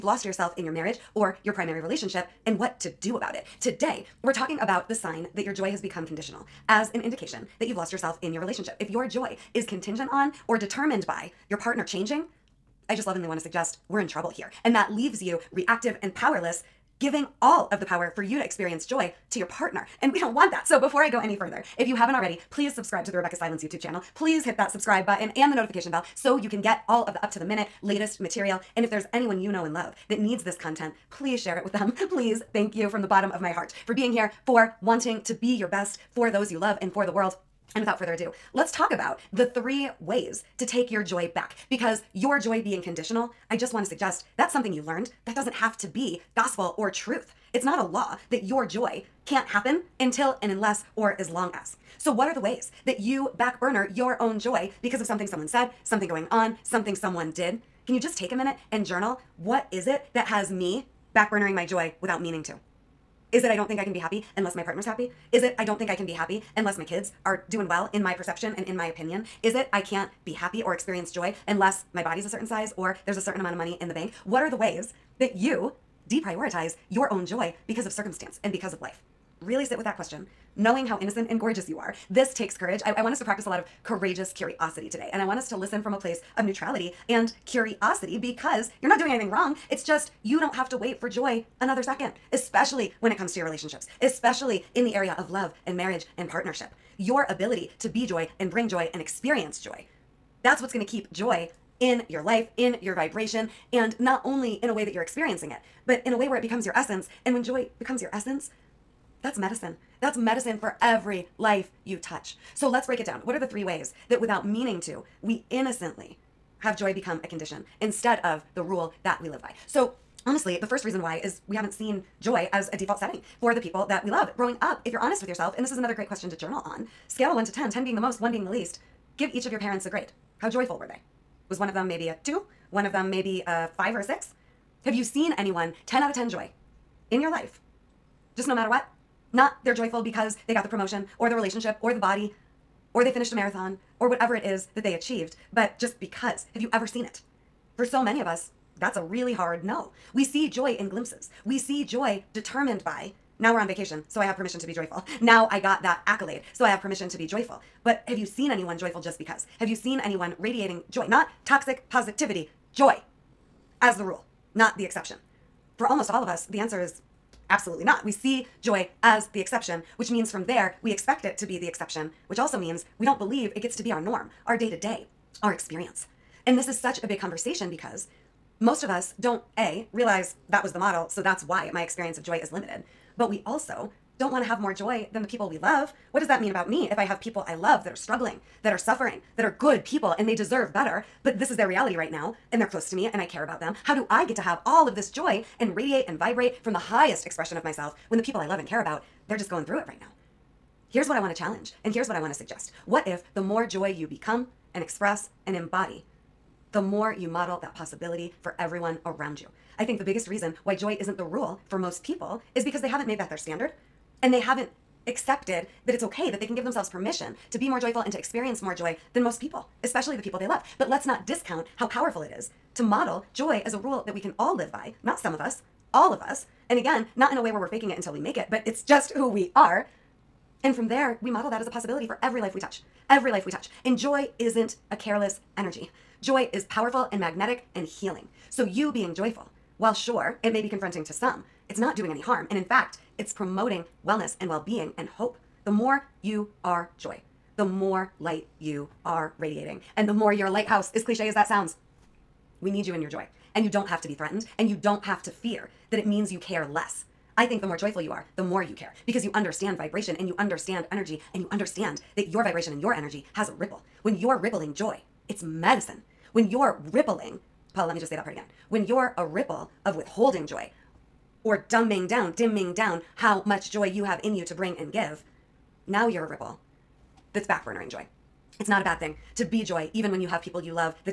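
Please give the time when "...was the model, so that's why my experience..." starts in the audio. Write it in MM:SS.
03:00.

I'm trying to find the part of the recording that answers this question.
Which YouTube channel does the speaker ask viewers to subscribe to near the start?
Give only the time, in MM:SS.
00:23.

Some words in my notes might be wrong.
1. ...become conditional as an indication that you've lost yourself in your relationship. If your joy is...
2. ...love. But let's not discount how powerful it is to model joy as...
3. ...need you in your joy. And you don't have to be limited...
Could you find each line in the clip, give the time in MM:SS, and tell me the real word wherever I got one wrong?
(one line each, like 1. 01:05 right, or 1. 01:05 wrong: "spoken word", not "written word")
1. 00:05 right
2. 03:40 right
3. 04:12 wrong: "threatened", not "limited".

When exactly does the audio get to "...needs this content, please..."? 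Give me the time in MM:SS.
00:30.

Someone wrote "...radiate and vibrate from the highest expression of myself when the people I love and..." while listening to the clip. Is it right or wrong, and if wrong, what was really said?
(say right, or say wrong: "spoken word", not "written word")
right.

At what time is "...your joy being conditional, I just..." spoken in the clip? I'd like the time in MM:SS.
00:42.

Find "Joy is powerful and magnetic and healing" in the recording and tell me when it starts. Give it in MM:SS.
03:56.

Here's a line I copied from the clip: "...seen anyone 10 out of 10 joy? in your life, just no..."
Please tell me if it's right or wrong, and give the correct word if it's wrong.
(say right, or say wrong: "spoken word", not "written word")
right.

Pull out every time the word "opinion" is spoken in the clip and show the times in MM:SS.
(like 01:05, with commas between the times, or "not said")
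01:08.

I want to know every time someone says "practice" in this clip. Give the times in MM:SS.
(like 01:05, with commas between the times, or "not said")
01:23.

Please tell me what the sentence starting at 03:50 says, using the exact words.
And from there, we model that as a possibility for every life we touch.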